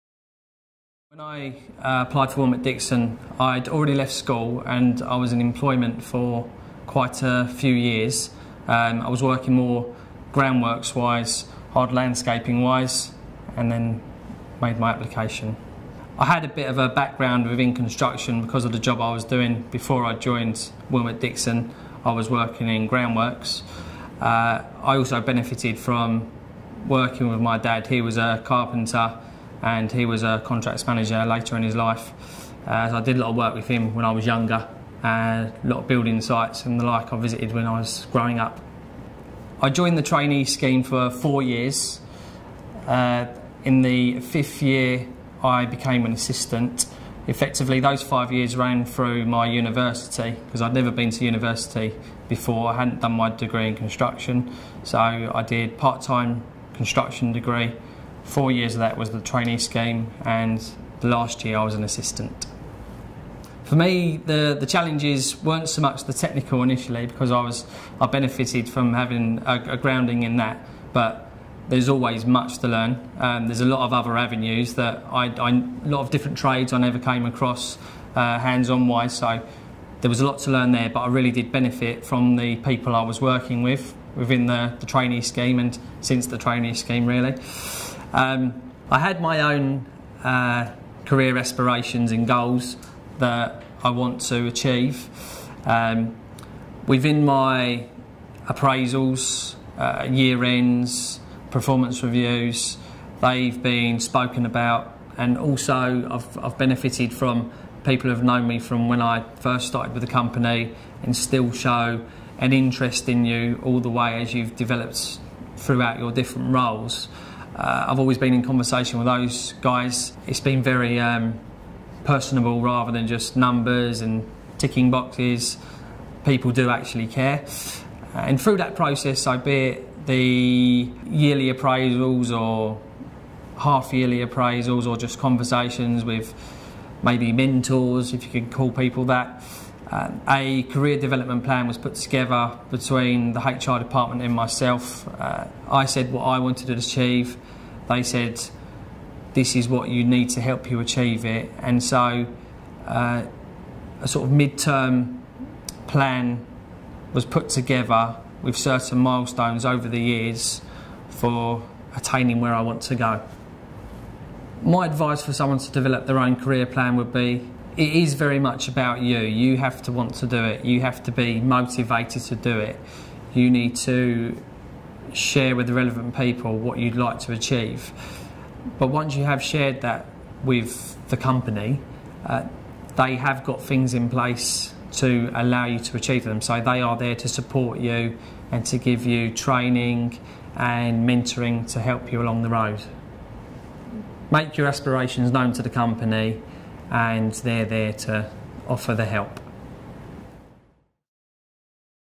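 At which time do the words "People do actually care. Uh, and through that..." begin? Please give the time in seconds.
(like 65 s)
126 s.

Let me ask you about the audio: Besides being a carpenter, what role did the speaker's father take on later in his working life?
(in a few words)
Contracts manager.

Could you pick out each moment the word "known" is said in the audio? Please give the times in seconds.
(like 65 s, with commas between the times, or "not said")
108 s, 195 s.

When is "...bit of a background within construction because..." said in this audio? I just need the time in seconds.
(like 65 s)
16 s.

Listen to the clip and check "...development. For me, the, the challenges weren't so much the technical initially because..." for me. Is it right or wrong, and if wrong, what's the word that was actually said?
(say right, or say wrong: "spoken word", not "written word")
wrong: "assistant", not "development".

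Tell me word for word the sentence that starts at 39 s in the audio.
I joined the trainee scheme for four years.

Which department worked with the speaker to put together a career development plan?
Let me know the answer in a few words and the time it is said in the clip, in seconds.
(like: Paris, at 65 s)
HR, at 143 s.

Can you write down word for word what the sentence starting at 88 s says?
Um, I had my own uh, career aspirations and goals that I want to achieve.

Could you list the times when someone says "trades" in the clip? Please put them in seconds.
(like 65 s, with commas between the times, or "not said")
76 s.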